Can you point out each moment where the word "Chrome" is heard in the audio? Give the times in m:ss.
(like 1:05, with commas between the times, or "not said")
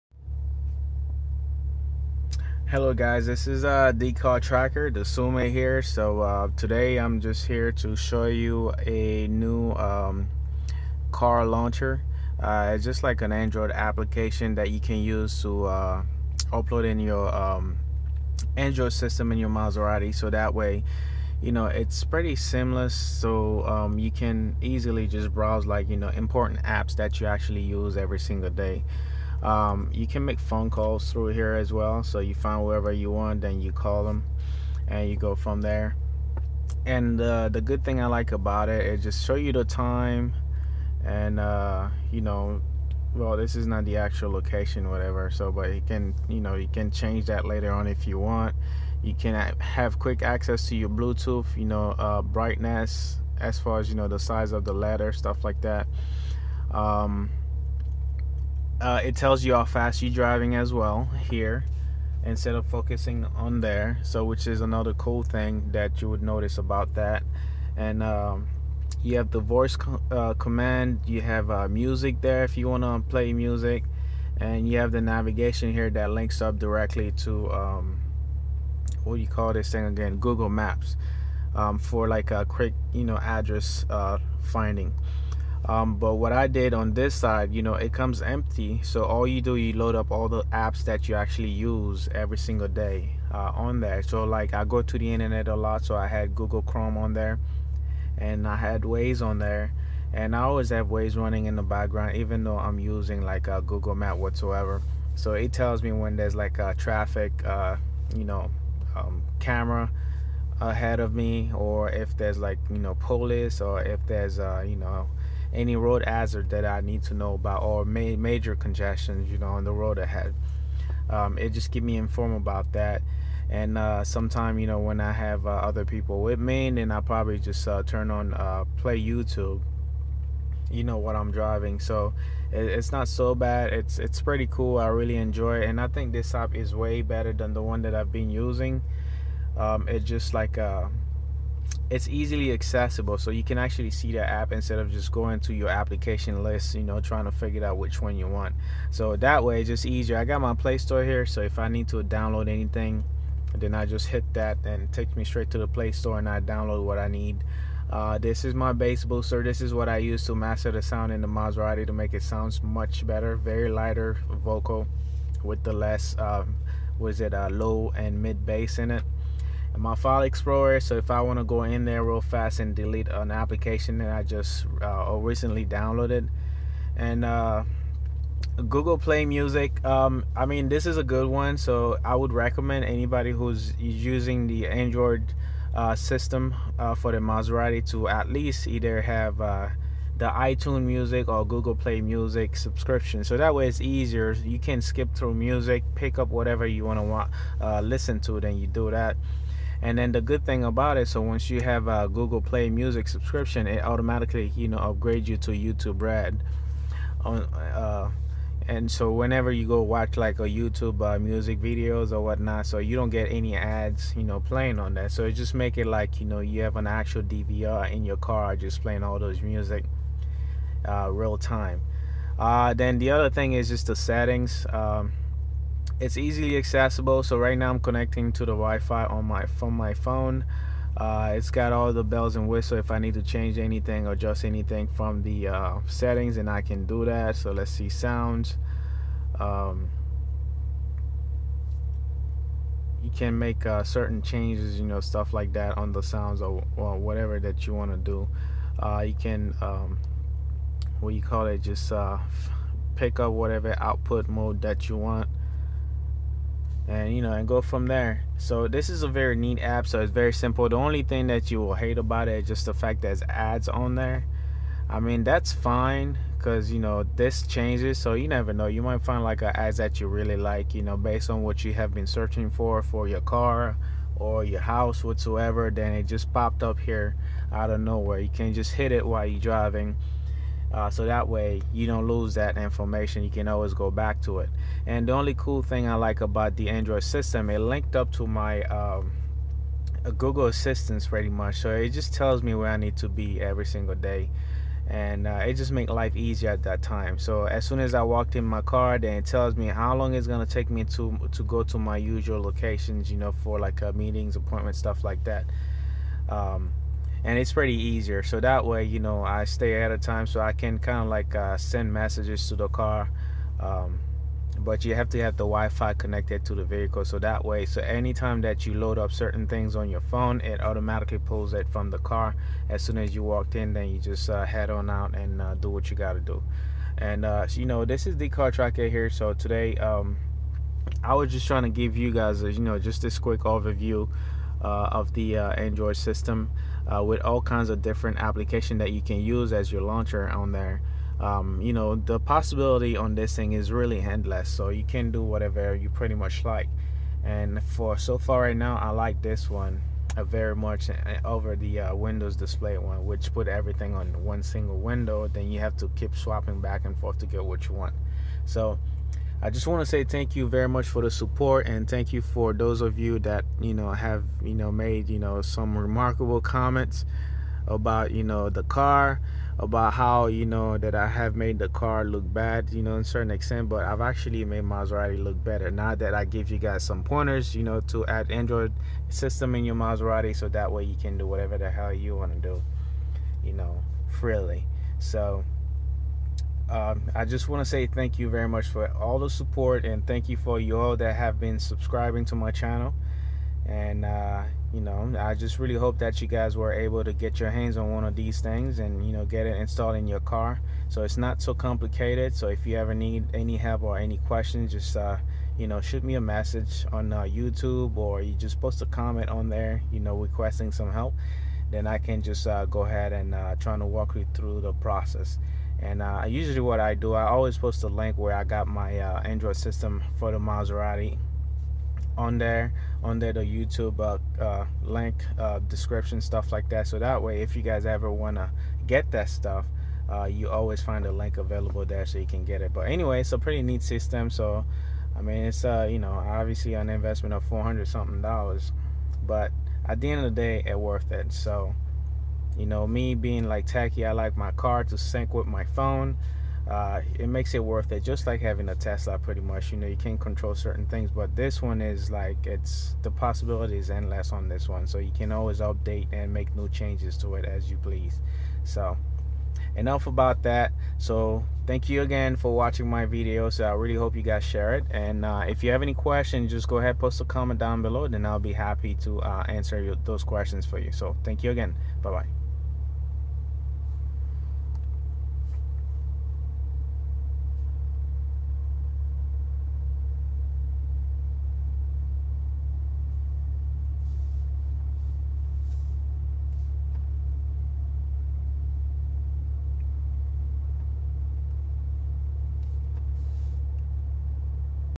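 1:36.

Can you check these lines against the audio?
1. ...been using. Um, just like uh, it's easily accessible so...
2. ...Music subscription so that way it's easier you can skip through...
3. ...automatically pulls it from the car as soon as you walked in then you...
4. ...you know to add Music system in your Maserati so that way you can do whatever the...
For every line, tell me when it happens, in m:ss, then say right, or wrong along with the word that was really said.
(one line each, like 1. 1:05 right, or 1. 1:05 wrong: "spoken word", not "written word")
1. 2:18 right
2. 3:12 right
3. 5:20 right
4. 6:17 wrong: "Android", not "Music".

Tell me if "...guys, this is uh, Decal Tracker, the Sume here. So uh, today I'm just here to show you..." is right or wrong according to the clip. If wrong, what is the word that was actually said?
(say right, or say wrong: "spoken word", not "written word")
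right.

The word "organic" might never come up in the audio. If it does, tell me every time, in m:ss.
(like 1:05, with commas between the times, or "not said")
not said.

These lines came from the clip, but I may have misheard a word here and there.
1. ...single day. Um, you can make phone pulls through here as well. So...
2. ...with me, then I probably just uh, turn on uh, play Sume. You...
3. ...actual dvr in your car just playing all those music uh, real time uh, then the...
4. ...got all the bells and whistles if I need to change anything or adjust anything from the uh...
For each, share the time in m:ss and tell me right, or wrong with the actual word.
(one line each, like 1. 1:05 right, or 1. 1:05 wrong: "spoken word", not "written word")
1. 0:28 wrong: "calls", not "pulls"
2. 2:06 wrong: "YouTube", not "Sume"
3. 3:36 right
4. 3:51 right.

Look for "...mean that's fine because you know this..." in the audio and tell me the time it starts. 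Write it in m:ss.
4:24.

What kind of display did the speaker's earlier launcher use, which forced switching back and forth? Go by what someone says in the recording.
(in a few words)
Windows display.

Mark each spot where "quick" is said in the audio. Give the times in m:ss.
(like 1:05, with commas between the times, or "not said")
0:49, 1:22, 5:33.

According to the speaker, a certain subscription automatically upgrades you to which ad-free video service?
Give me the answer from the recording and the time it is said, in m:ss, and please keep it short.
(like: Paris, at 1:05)
YouTube Red, at 3:25.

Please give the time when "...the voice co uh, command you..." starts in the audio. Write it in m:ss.
1:09.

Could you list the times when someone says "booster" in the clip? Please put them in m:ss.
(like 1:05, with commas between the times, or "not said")
2:39.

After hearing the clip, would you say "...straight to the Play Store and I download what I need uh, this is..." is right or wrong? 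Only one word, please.
right.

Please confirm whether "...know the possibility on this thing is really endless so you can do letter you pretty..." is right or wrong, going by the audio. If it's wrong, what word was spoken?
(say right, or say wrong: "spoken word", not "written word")
wrong: "whatever", not "letter".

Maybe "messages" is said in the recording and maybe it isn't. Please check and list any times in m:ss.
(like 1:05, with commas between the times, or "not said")
5:11, 6:46.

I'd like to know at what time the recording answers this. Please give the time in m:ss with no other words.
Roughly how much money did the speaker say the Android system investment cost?
7:17.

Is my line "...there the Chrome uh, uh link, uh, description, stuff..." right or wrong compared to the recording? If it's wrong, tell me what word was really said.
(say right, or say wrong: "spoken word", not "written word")
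wrong: "YouTube", not "Chrome".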